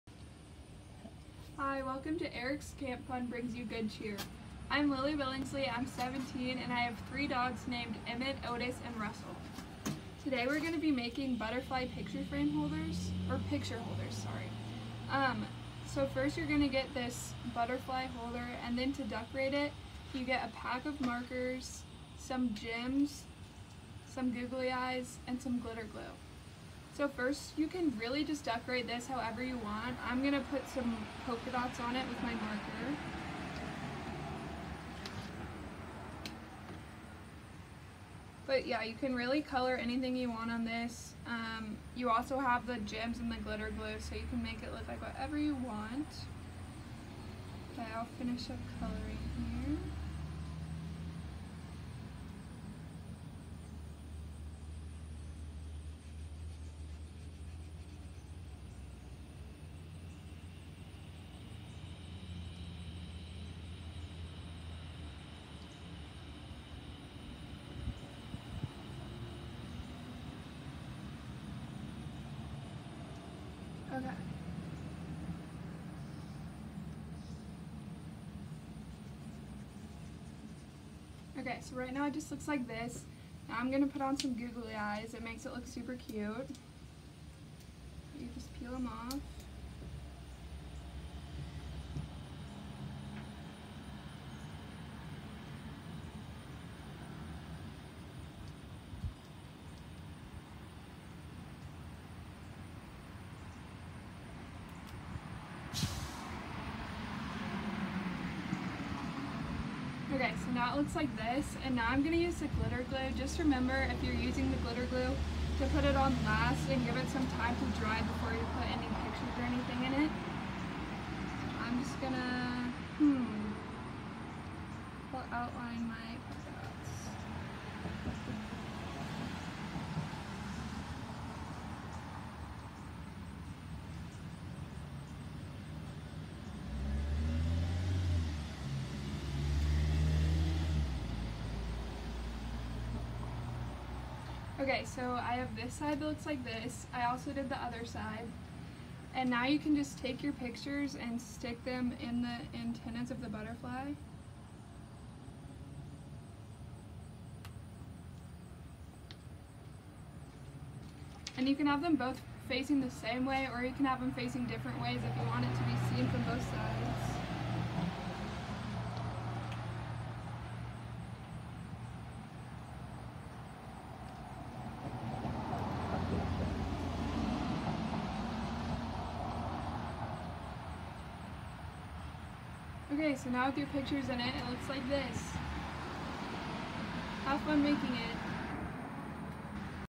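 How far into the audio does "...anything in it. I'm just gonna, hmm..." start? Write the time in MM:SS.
01:59.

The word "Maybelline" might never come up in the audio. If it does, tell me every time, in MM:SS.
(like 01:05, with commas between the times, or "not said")
not said.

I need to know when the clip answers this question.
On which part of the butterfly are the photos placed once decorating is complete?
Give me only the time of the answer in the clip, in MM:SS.
02:32.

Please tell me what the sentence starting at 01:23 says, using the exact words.
Now I'm going to put on some googly eyes.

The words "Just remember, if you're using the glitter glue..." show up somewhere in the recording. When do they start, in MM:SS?
01:53.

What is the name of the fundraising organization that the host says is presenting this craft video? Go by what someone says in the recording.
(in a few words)
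Eric's Camp Fund.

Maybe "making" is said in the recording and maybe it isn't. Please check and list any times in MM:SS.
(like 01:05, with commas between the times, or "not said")
00:10, 03:07.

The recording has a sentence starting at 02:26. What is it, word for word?
I also did the other side.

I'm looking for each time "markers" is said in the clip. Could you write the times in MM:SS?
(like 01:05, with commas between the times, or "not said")
00:20, 00:32.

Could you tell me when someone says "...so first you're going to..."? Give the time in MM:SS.
00:15.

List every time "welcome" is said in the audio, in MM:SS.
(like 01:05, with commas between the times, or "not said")
00:01.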